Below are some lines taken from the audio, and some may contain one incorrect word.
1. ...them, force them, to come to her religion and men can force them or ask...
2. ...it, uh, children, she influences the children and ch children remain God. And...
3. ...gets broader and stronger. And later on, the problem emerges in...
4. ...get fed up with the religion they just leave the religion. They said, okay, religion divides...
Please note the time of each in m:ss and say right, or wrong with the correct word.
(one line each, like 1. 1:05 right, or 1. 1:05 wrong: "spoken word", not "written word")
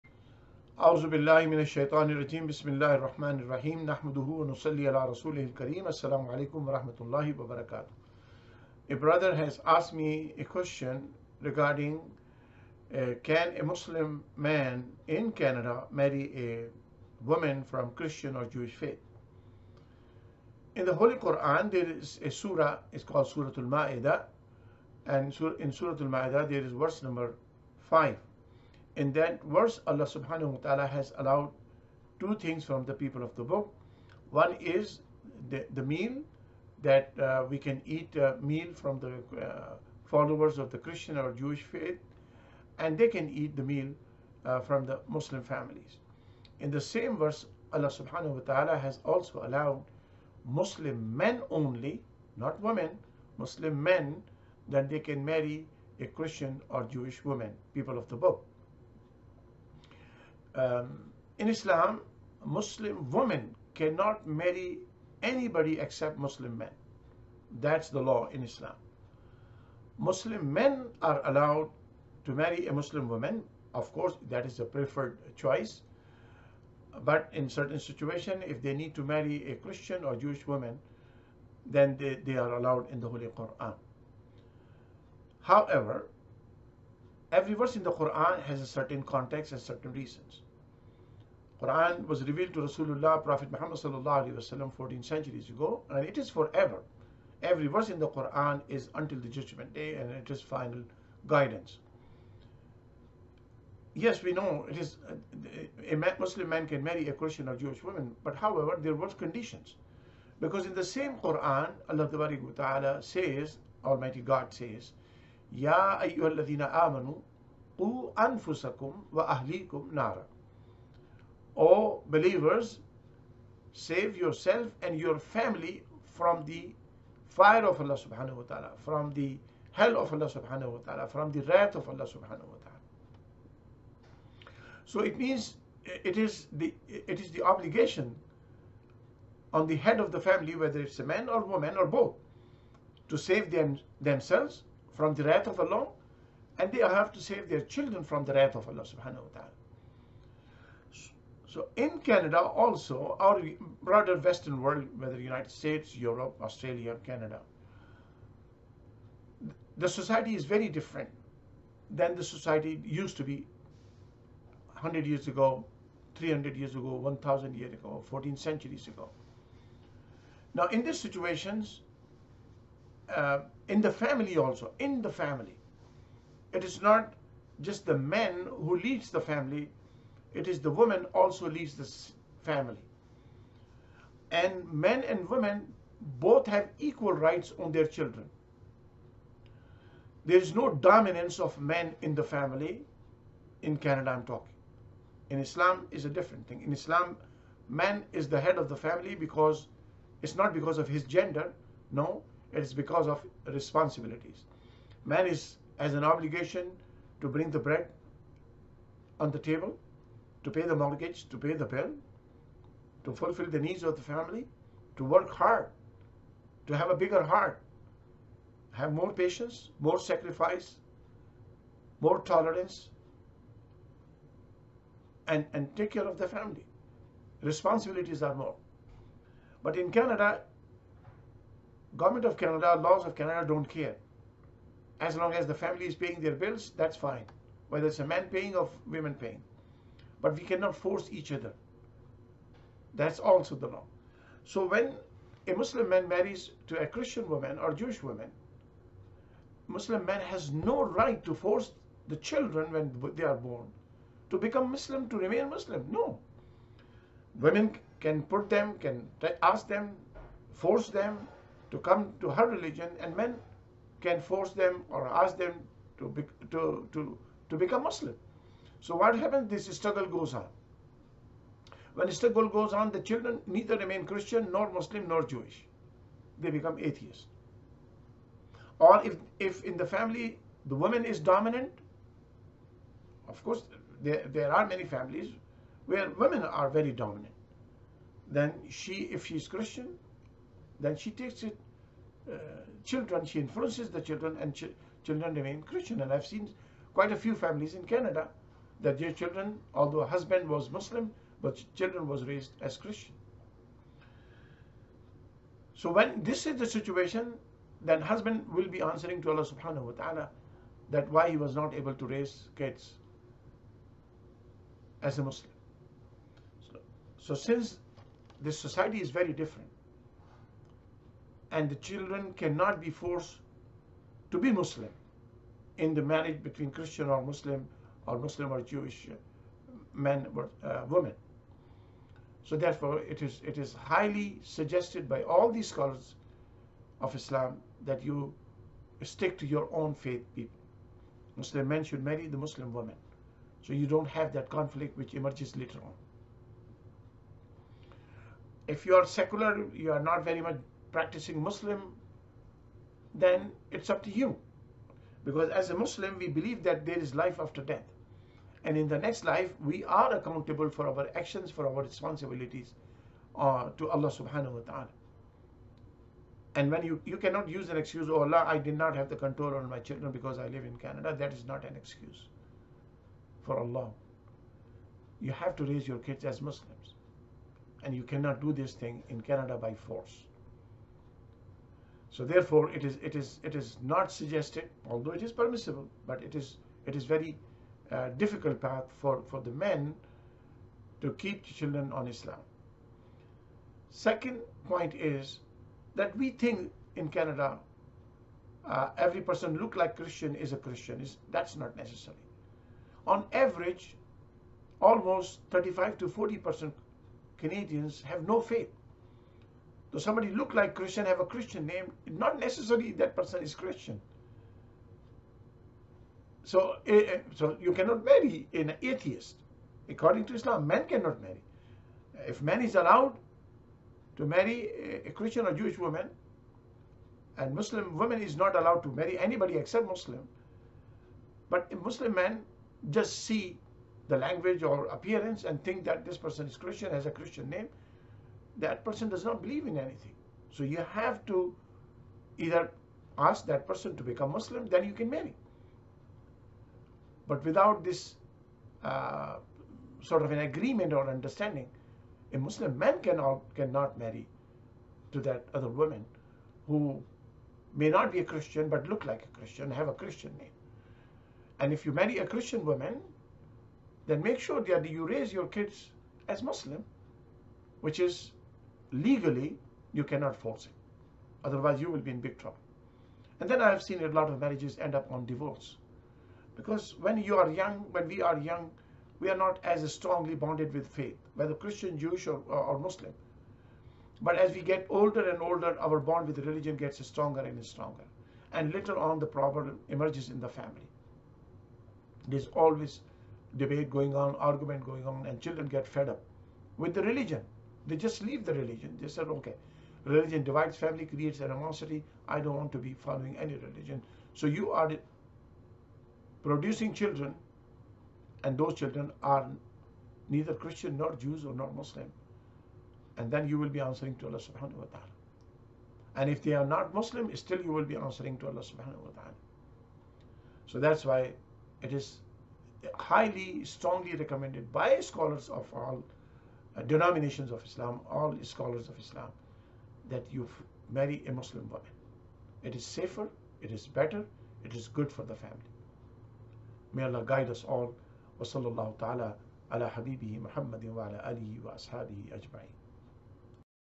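1. 4:19 right
2. 4:51 wrong: "Christian", not "God"
3. 8:06 wrong: "stronger", not "broader"
4. 8:15 right.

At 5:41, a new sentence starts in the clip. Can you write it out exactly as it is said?
Muslim men should marry the Muslim woman.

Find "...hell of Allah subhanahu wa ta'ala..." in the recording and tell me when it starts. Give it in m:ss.
2:09.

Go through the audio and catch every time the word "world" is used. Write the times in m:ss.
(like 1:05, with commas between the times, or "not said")
2:34.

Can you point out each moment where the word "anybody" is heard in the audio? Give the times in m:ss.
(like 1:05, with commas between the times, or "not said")
1:05, 7:09.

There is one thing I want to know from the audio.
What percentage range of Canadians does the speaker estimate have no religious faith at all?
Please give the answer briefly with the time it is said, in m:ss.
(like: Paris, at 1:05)
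35 to 40 percent, at 6:45.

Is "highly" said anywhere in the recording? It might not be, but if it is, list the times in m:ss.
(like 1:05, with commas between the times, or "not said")
5:33, 8:42.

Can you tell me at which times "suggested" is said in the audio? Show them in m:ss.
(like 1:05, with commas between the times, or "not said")
5:34, 6:24.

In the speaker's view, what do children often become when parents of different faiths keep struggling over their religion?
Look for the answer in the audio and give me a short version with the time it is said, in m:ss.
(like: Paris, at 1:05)
atheists, at 4:36.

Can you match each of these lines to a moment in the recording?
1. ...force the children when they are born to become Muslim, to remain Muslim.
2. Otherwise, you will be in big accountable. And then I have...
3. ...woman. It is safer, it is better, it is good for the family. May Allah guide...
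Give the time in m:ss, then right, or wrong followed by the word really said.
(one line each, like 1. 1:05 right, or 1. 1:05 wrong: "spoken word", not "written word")
1. 4:11 right
2. 7:51 wrong: "trouble", not "accountable"
3. 8:51 right.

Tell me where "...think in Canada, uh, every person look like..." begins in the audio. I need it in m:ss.
6:36.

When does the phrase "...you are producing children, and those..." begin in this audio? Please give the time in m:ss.
8:24.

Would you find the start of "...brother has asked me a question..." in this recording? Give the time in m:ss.
0:08.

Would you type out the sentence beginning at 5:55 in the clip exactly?
Because as a Muslim, we believe that there is life after death.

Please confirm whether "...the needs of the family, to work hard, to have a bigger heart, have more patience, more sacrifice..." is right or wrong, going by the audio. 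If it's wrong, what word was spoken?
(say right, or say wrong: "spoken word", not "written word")
right.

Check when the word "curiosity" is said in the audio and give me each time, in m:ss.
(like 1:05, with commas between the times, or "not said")
not said.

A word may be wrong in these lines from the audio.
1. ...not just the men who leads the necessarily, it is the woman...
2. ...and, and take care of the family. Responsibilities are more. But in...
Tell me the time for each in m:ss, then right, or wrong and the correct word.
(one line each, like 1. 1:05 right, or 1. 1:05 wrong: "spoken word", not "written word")
1. 2:56 wrong: "family", not "necessarily"
2. 3:45 right.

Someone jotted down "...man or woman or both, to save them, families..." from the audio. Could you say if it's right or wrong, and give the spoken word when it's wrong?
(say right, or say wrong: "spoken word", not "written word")
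wrong: "themselves", not "families".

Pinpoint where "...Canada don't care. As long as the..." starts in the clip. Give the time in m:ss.
3:53.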